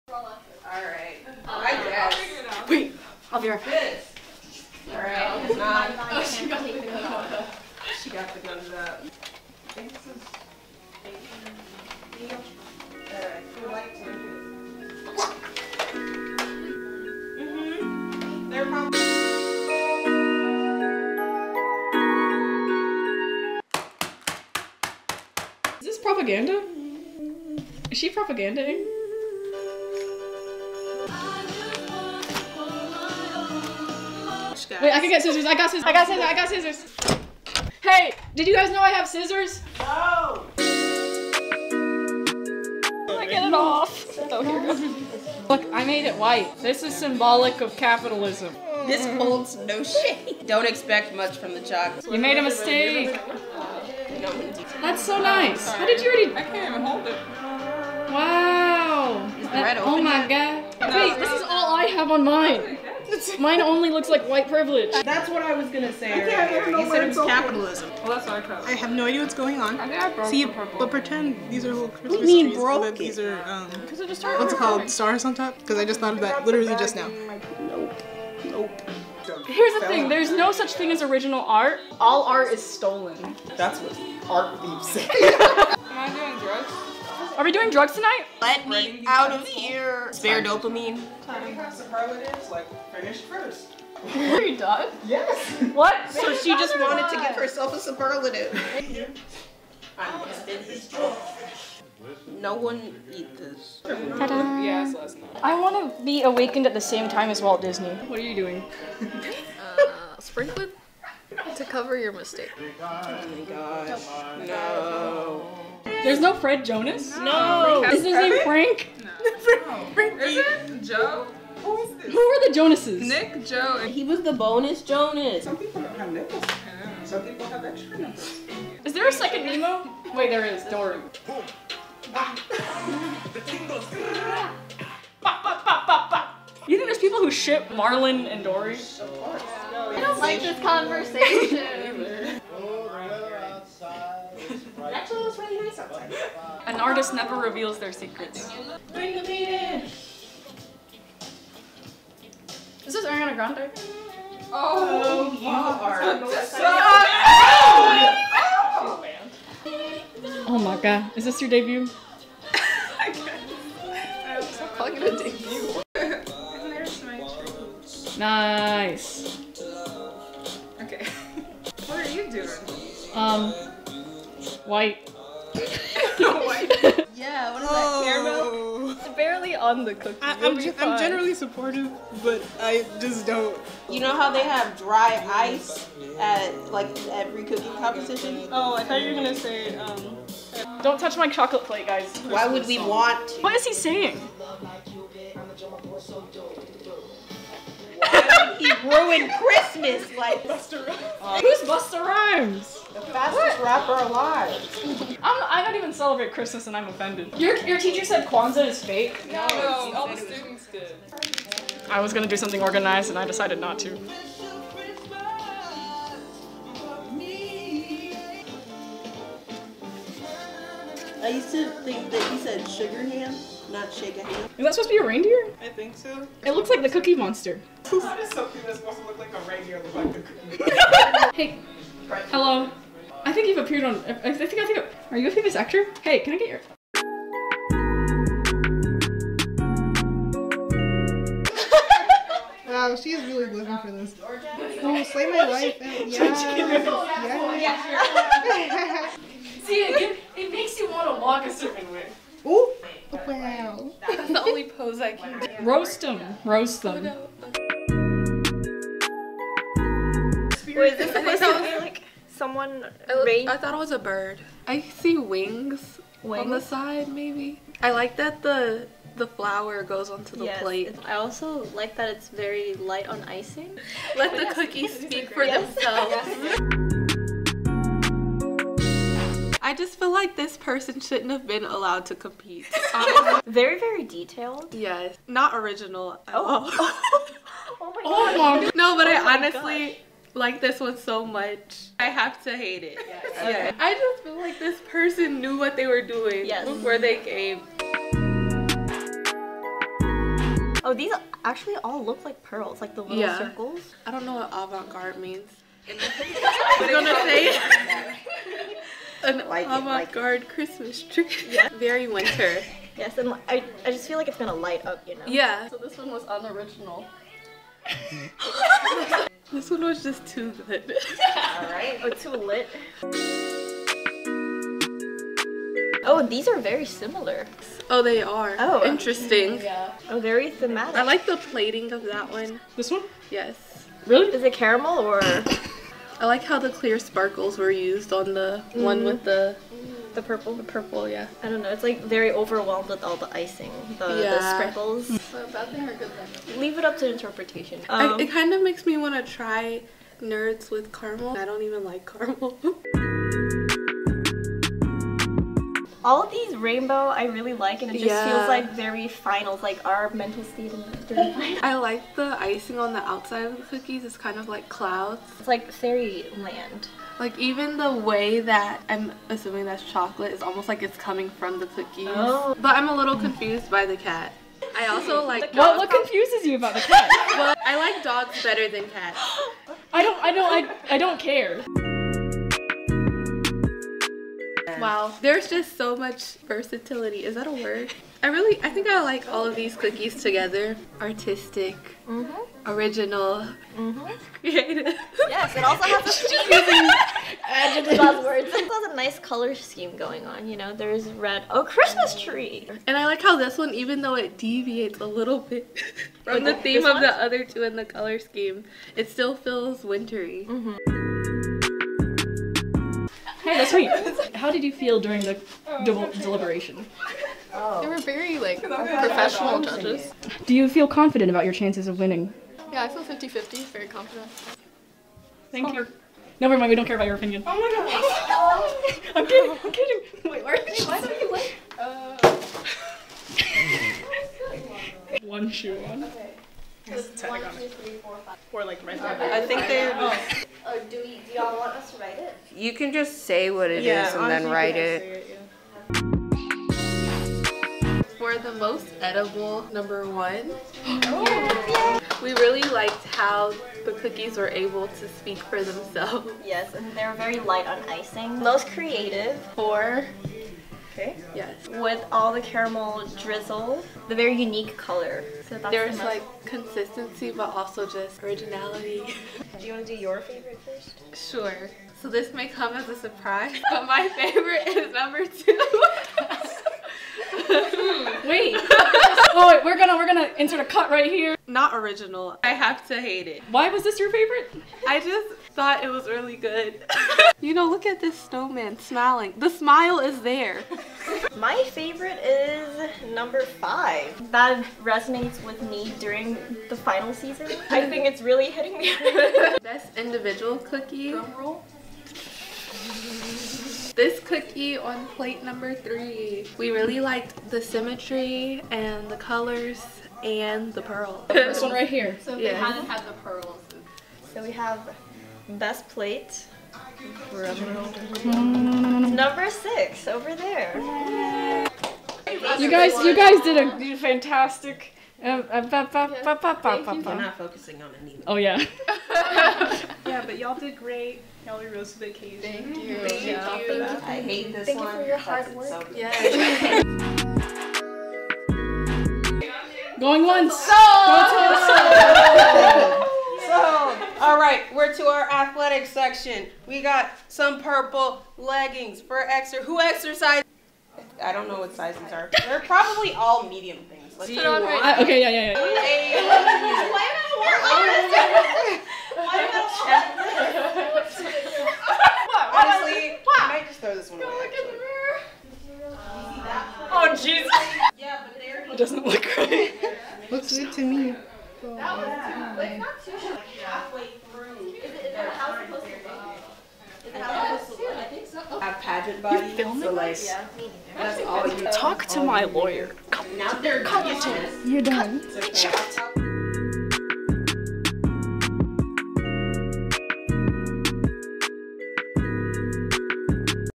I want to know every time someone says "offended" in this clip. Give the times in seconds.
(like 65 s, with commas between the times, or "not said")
206 s.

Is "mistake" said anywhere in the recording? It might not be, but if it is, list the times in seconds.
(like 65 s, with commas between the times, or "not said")
52 s, 112 s.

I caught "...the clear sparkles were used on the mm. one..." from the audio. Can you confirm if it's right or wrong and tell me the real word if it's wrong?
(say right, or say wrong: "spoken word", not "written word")
right.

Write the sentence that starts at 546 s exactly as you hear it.
We got some purple leggings for exer.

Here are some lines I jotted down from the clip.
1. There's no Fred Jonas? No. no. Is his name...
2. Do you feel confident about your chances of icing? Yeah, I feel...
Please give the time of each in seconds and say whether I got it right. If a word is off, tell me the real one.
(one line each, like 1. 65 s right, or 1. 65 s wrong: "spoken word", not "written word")
1. 116 s right
2. 420 s wrong: "winning", not "icing".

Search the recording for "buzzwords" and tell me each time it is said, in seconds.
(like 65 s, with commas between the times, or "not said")
397 s.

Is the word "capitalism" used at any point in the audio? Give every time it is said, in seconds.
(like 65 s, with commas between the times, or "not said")
47 s, 67 s.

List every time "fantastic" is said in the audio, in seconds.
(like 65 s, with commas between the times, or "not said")
523 s.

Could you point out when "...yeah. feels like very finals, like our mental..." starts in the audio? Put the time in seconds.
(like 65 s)
358 s.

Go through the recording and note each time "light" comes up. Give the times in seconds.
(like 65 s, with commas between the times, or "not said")
272 s, 314 s, 457 s.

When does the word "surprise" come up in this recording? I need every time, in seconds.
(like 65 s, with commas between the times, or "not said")
472 s.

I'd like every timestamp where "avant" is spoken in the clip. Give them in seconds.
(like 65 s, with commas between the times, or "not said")
304 s, 309 s.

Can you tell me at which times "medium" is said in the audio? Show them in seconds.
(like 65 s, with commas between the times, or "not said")
553 s.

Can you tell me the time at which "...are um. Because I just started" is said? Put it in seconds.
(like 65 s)
73 s.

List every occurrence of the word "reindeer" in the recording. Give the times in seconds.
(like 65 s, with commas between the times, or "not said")
225 s, 229 s.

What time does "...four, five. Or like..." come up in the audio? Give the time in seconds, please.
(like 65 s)
437 s.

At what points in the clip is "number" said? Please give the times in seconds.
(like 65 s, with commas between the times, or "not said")
449 s, 474 s, 493 s, 505 s, 517 s.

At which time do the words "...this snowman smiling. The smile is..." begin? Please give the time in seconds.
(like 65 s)
487 s.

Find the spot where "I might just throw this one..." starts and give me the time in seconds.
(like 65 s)
563 s.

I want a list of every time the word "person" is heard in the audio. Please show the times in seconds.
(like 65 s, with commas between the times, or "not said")
280 s, 294 s.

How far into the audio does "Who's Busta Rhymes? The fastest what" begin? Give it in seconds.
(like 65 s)
201 s.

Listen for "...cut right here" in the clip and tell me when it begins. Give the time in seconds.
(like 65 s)
480 s.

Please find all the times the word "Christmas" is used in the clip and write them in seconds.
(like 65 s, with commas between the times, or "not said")
71 s, 199 s, 206 s, 310 s, 401 s.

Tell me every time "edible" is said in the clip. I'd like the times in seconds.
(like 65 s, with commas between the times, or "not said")
449 s.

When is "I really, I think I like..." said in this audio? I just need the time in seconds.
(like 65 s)
388 s.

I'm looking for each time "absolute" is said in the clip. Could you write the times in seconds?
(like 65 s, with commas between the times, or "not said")
not said.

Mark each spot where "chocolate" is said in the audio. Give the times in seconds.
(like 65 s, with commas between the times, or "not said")
51 s, 191 s, 369 s.